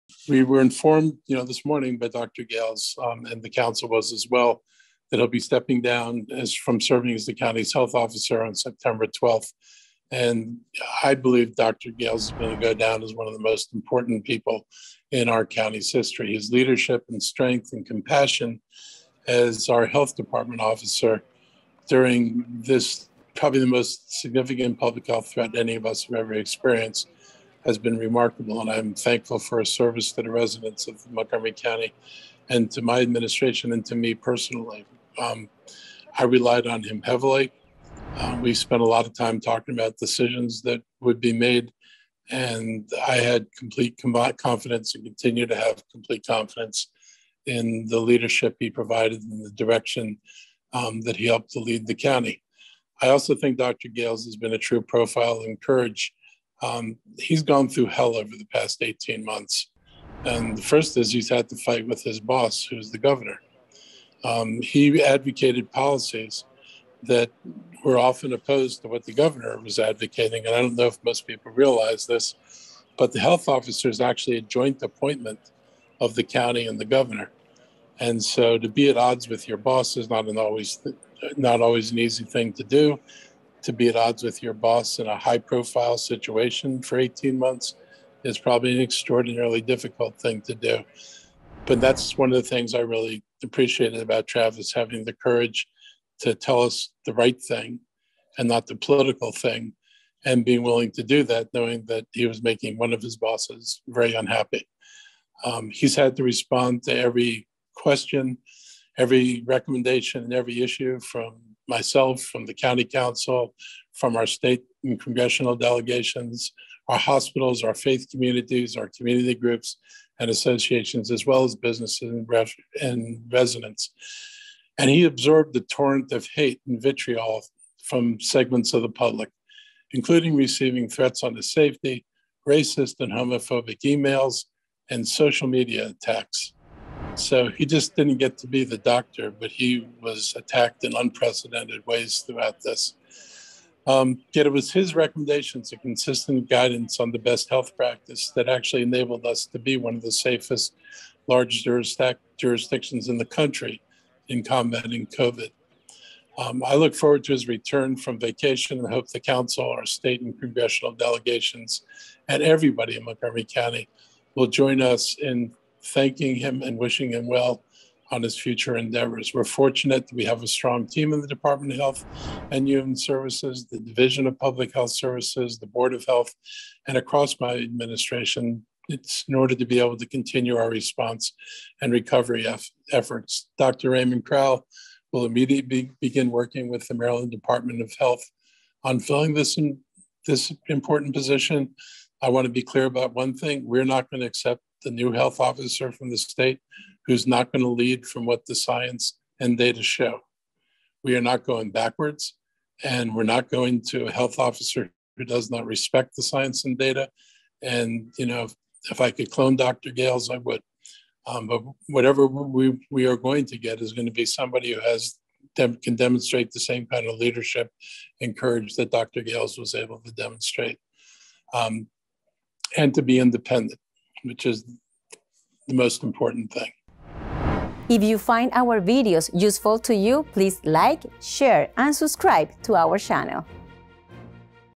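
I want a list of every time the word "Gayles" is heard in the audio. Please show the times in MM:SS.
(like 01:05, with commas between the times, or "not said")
00:02, 00:11, 00:53, 03:29, 03:39.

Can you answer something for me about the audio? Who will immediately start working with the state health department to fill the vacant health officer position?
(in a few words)
Dr. Raymond Crowel.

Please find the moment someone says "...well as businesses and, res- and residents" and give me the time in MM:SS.
02:01.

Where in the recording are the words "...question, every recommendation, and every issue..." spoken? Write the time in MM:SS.
01:47.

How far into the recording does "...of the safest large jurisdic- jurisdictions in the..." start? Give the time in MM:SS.
02:29.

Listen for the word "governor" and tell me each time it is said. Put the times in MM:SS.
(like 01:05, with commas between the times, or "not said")
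01:02, 01:09, 01:16.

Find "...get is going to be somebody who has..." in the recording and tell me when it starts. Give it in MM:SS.
03:33.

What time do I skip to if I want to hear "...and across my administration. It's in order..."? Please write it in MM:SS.
02:56.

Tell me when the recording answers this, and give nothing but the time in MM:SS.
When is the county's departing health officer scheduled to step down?
00:08.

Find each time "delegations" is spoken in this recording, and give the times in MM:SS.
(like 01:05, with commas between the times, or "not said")
01:55, 02:40.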